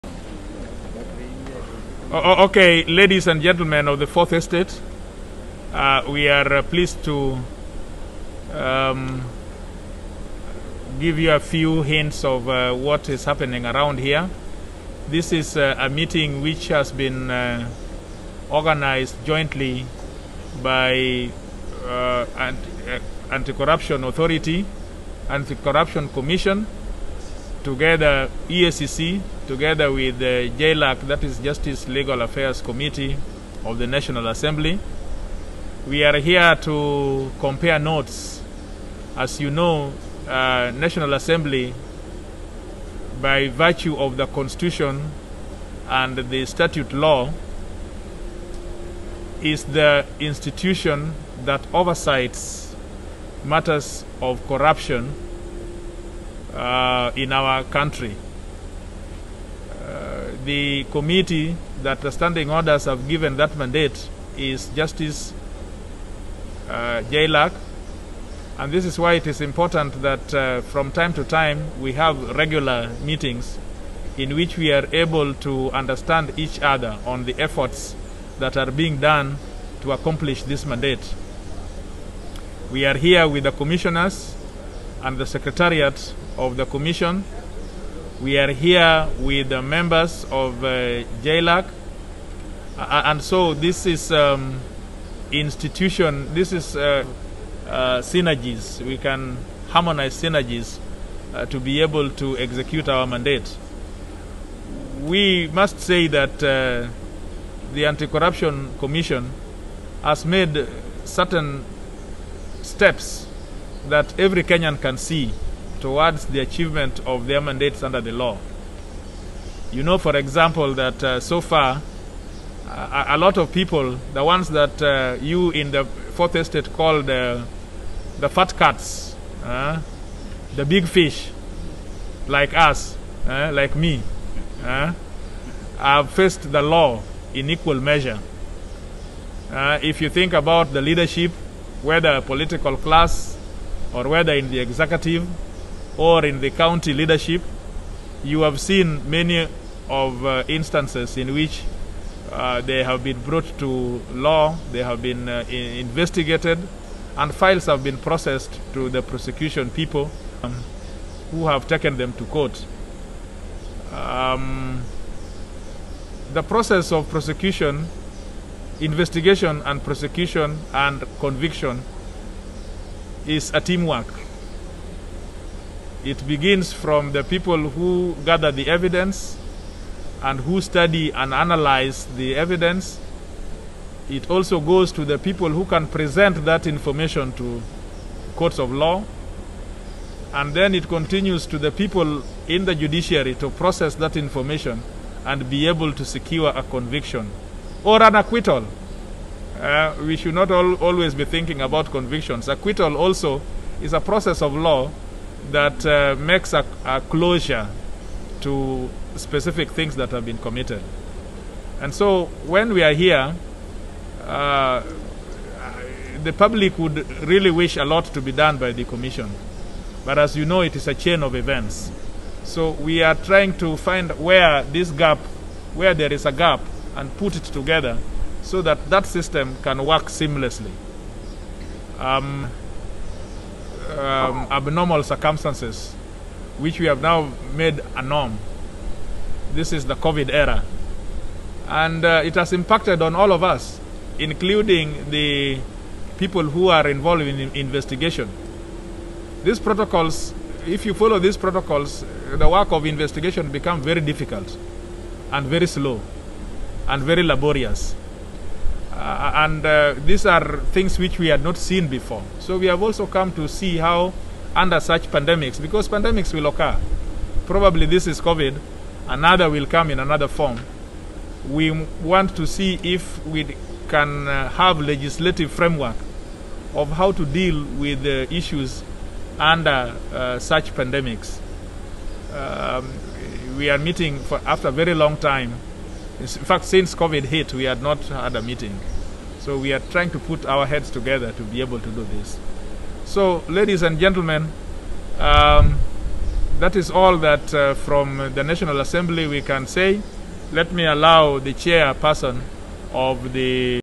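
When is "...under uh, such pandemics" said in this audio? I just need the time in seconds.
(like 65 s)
279 s.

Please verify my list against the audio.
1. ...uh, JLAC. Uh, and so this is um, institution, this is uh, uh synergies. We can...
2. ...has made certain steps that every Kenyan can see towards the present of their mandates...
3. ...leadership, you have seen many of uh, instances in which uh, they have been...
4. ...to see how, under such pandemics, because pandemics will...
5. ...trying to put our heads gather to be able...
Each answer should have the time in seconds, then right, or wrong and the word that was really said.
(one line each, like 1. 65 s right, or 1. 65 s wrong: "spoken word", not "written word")
1. 90 s right
2. 110 s wrong: "achievement", not "present"
3. 146 s right
4. 263 s right
5. 289 s wrong: "together", not "gather".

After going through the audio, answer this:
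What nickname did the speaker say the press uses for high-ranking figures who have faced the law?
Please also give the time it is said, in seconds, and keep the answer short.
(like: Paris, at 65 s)
fat cats, at 128 s.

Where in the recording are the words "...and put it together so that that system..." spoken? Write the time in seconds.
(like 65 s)
226 s.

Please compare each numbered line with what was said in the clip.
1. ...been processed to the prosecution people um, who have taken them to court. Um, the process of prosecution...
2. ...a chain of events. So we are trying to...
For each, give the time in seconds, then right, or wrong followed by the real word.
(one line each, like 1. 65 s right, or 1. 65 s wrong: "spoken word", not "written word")
1. 157 s right
2. 220 s right.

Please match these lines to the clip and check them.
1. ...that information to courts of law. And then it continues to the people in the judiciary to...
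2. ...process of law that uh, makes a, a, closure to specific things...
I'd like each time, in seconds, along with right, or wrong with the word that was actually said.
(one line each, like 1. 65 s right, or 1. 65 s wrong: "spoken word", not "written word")
1. 186 s right
2. 203 s right.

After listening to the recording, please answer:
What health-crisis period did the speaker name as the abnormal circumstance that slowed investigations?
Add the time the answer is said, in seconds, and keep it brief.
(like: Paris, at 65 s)
COVID era, at 239 s.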